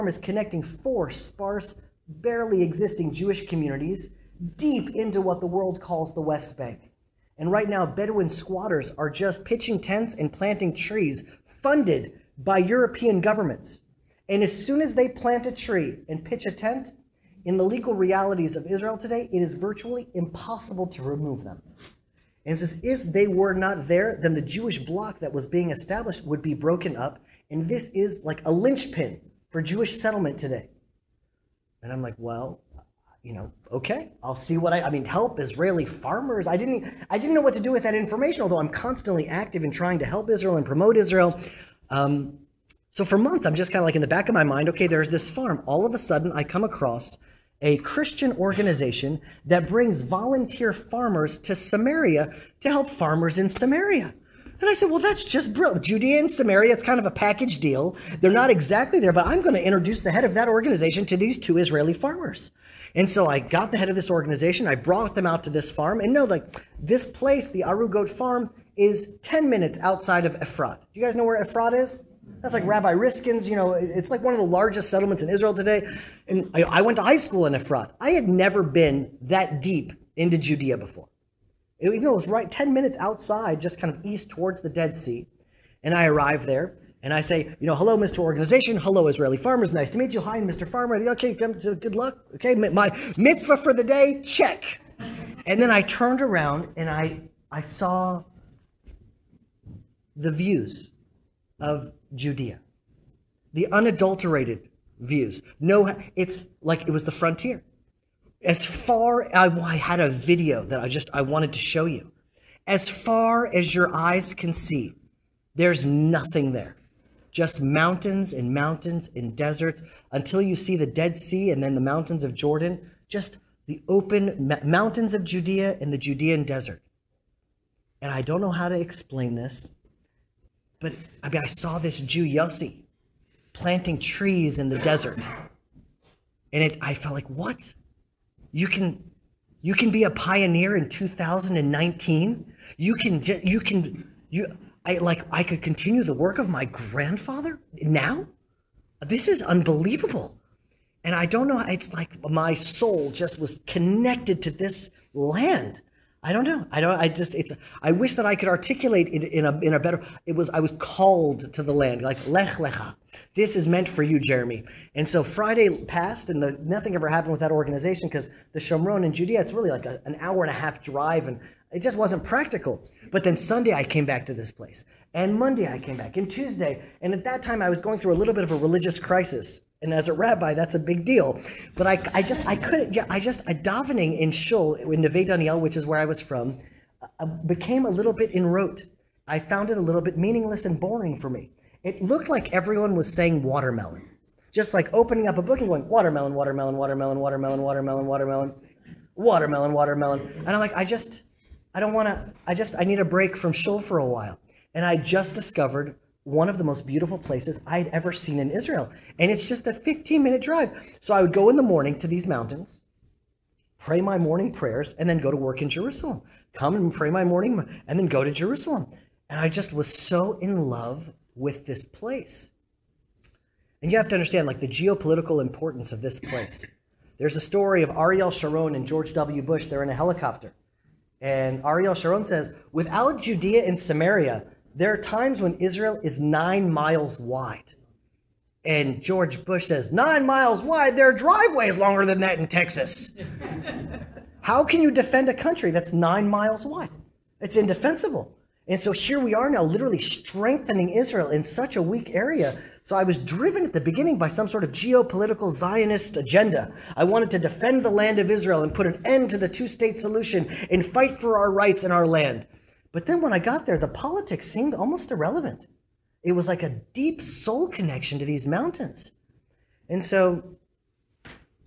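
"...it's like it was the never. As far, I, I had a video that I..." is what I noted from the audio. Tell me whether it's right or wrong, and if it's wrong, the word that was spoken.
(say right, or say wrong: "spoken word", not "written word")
wrong: "frontier", not "never".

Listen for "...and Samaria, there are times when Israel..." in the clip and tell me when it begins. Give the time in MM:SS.
03:53.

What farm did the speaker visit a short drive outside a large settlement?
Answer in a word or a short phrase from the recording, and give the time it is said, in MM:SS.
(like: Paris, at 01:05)
Arugot farm, at 01:07.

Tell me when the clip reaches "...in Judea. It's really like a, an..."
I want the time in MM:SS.
02:49.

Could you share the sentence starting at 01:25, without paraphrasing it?
And I arrive there and I say, you know, hello, Mr.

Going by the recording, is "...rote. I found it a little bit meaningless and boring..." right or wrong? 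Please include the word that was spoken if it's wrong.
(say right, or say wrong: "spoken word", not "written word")
right.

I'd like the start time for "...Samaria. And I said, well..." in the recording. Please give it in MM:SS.
00:53.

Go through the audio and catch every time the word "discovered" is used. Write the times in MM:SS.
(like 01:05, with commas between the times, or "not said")
03:25.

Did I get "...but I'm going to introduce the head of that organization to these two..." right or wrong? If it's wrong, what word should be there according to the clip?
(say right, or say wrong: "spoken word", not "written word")
right.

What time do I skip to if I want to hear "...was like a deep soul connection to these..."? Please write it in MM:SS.
04:26.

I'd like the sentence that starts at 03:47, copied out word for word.
There's a story of Ariel Sharon and George W.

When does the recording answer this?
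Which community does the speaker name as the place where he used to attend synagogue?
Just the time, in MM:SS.
03:05.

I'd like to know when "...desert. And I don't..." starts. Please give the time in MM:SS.
02:06.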